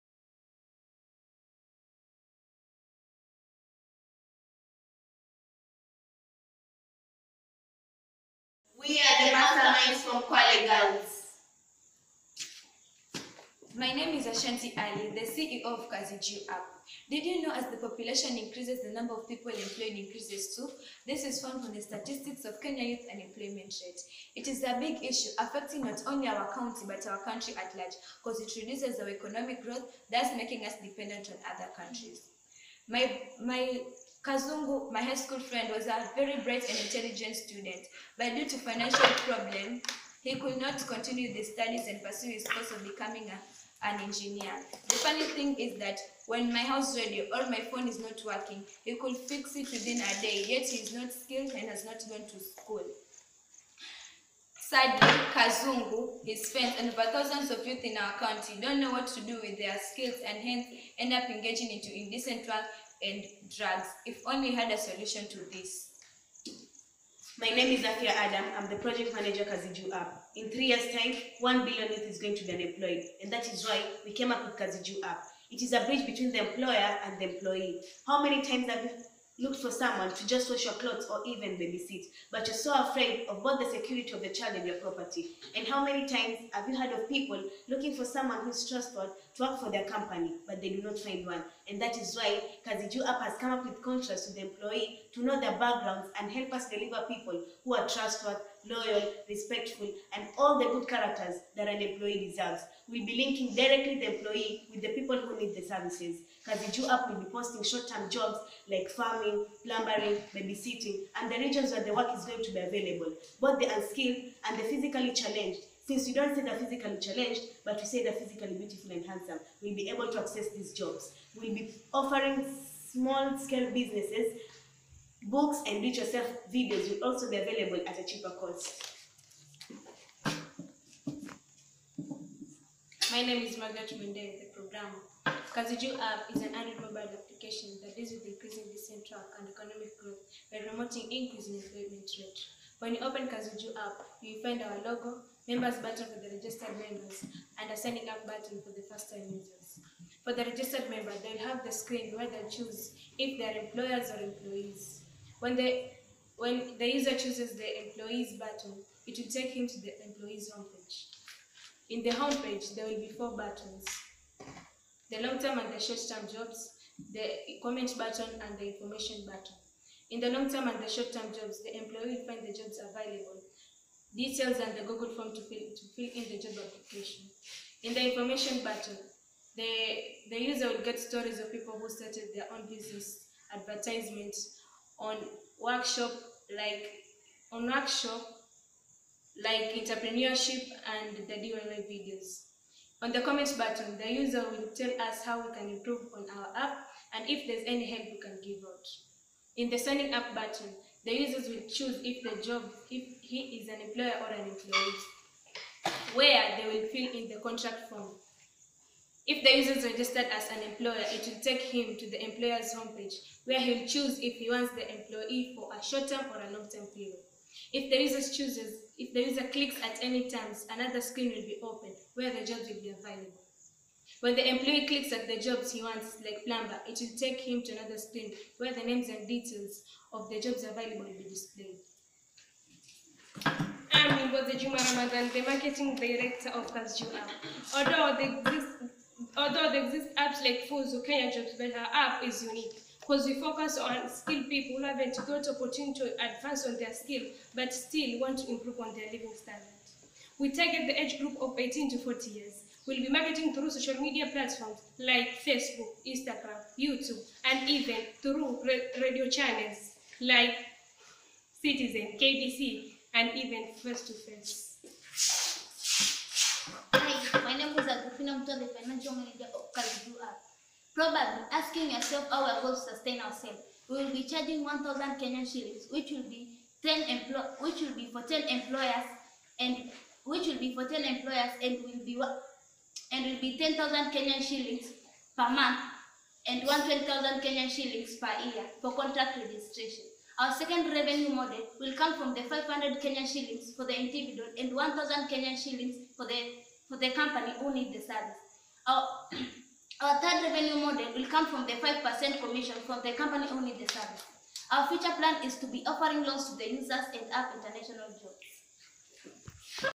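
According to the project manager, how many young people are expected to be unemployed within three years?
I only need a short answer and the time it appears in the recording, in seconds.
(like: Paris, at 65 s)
1 billion, at 71 s.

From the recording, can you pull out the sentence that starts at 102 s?
We'll be linking directly the employee with the people who need the services.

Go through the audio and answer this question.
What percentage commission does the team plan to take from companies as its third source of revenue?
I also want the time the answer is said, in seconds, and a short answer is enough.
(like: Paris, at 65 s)
5%, at 301 s.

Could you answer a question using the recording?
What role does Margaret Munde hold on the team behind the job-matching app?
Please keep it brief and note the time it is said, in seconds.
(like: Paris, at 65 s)
Programmer, at 134 s.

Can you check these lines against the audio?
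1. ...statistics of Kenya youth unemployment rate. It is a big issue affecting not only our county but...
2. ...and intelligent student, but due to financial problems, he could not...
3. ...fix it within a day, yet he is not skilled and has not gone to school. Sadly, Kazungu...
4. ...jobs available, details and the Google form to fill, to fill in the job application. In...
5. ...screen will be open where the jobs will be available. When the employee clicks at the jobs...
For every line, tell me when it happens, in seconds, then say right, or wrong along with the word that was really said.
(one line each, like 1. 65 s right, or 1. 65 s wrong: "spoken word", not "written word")
1. 21 s right
2. 36 s right
3. 49 s right
4. 172 s right
5. 221 s right.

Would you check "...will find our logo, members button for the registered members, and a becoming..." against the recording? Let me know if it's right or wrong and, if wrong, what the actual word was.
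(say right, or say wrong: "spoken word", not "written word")
wrong: "signing", not "becoming".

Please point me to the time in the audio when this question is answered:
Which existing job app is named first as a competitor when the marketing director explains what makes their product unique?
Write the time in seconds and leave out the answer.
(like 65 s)
240 s.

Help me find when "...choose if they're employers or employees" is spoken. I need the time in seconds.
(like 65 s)
152 s.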